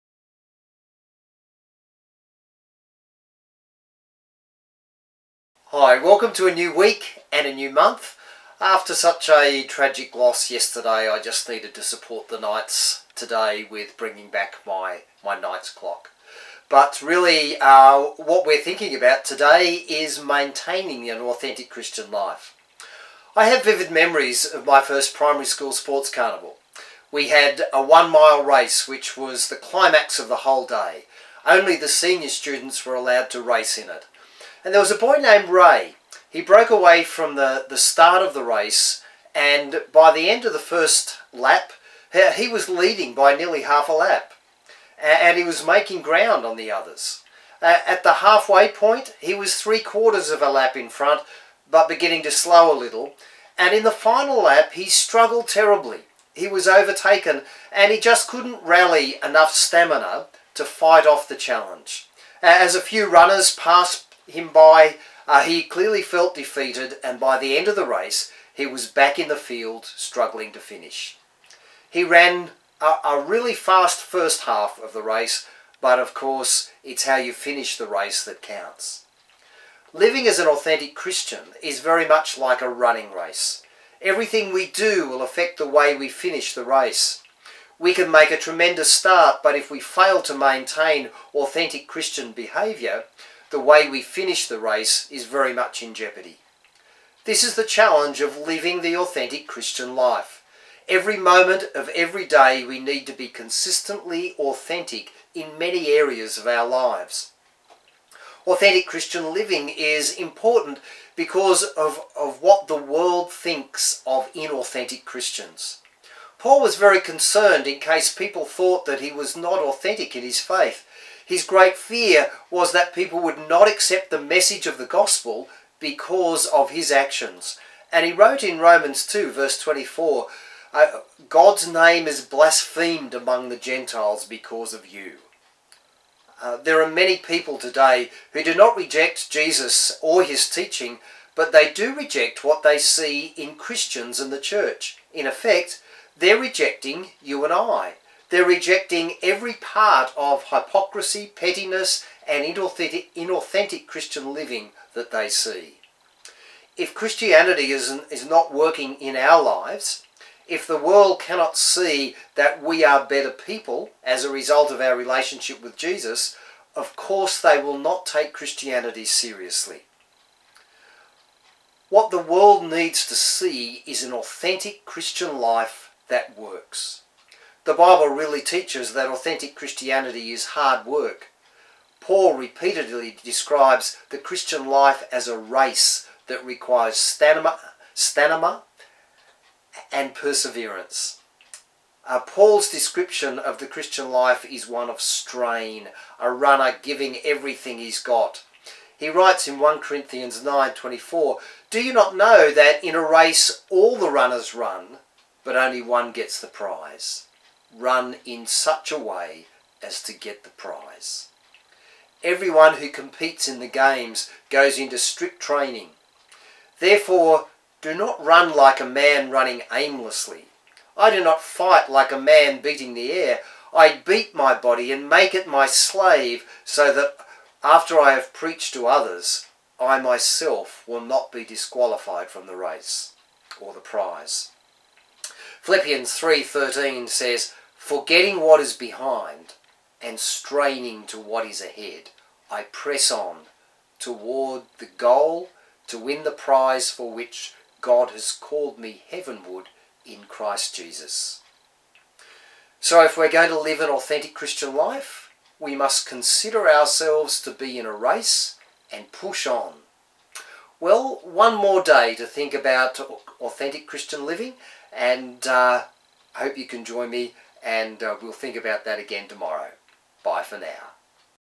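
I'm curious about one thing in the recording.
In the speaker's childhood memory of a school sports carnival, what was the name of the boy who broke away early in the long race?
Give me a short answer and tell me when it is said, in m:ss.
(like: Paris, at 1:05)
Ray, at 0:35.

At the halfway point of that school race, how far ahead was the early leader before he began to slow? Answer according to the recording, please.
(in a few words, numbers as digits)
Three quarters of a lap.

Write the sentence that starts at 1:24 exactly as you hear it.
Everything we do will affect the way we finish the race.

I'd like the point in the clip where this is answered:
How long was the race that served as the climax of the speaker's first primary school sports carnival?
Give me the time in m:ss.
0:27.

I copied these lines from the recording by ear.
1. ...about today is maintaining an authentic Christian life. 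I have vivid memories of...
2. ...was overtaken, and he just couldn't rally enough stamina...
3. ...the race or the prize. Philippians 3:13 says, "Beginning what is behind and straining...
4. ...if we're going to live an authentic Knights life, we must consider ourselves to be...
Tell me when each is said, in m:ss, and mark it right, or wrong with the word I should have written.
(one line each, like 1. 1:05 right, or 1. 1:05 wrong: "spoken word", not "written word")
1. 0:18 right
2. 0:56 right
3. 3:52 wrong: "Forgetting", not "Beginning"
4. 4:13 wrong: "Christian", not "Knights".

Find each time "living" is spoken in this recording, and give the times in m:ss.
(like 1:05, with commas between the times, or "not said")
1:19, 1:38, 1:49, 2:34, 4:24.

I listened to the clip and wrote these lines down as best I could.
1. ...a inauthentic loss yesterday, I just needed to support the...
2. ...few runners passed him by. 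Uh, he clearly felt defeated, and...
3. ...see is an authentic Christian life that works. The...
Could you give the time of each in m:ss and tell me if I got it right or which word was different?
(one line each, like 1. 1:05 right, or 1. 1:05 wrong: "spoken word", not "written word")
1. 0:09 wrong: "tragic", not "inauthentic"
2. 1:02 right
3. 2:53 right.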